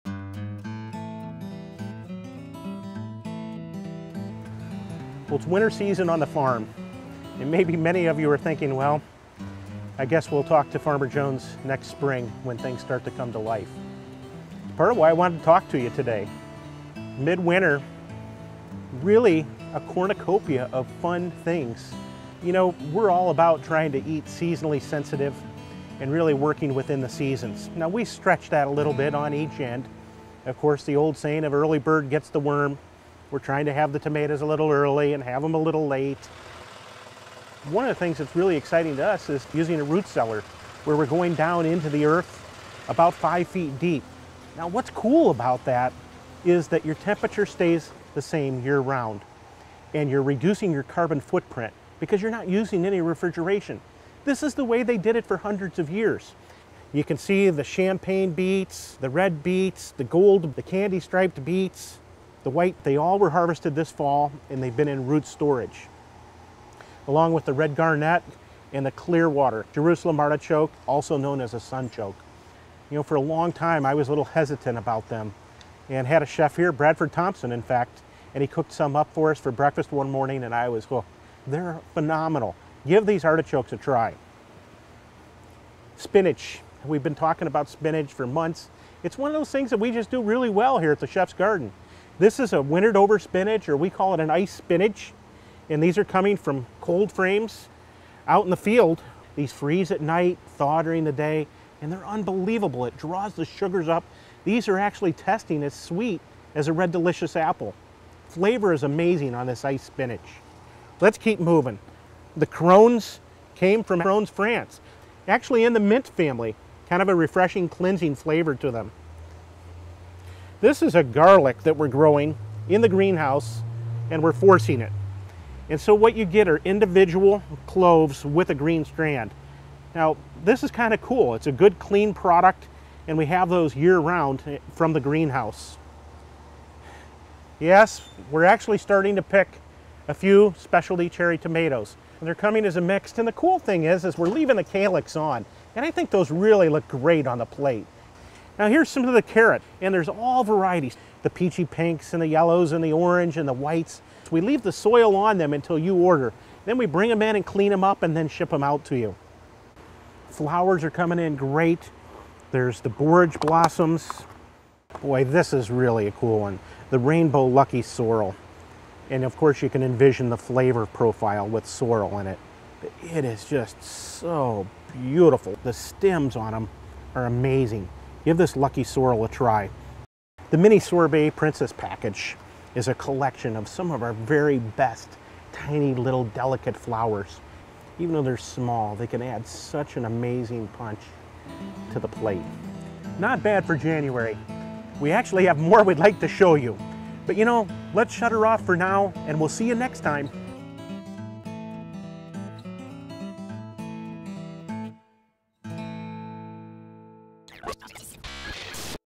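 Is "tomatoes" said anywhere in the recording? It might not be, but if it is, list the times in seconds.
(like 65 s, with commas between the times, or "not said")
33 s, 141 s.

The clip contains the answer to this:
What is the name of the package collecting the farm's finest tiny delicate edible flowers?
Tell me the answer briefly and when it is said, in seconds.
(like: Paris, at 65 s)
Mini Sorbet Princess, at 180 s.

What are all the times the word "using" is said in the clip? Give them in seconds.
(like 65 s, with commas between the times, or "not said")
39 s, 52 s.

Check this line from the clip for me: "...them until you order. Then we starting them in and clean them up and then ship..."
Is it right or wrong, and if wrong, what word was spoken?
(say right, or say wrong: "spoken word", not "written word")
wrong: "bring", not "starting".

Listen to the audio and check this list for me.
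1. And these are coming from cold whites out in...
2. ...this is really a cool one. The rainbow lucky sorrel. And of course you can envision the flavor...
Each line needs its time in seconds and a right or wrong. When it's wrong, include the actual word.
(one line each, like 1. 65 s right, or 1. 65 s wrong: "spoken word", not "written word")
1. 95 s wrong: "frames", not "whites"
2. 165 s right.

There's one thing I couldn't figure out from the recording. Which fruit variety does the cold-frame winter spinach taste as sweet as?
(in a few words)
red delicious apple.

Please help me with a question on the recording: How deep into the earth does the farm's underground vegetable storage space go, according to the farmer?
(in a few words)
5 feet.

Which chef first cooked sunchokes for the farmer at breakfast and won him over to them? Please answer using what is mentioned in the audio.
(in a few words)
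Bradford Thompson.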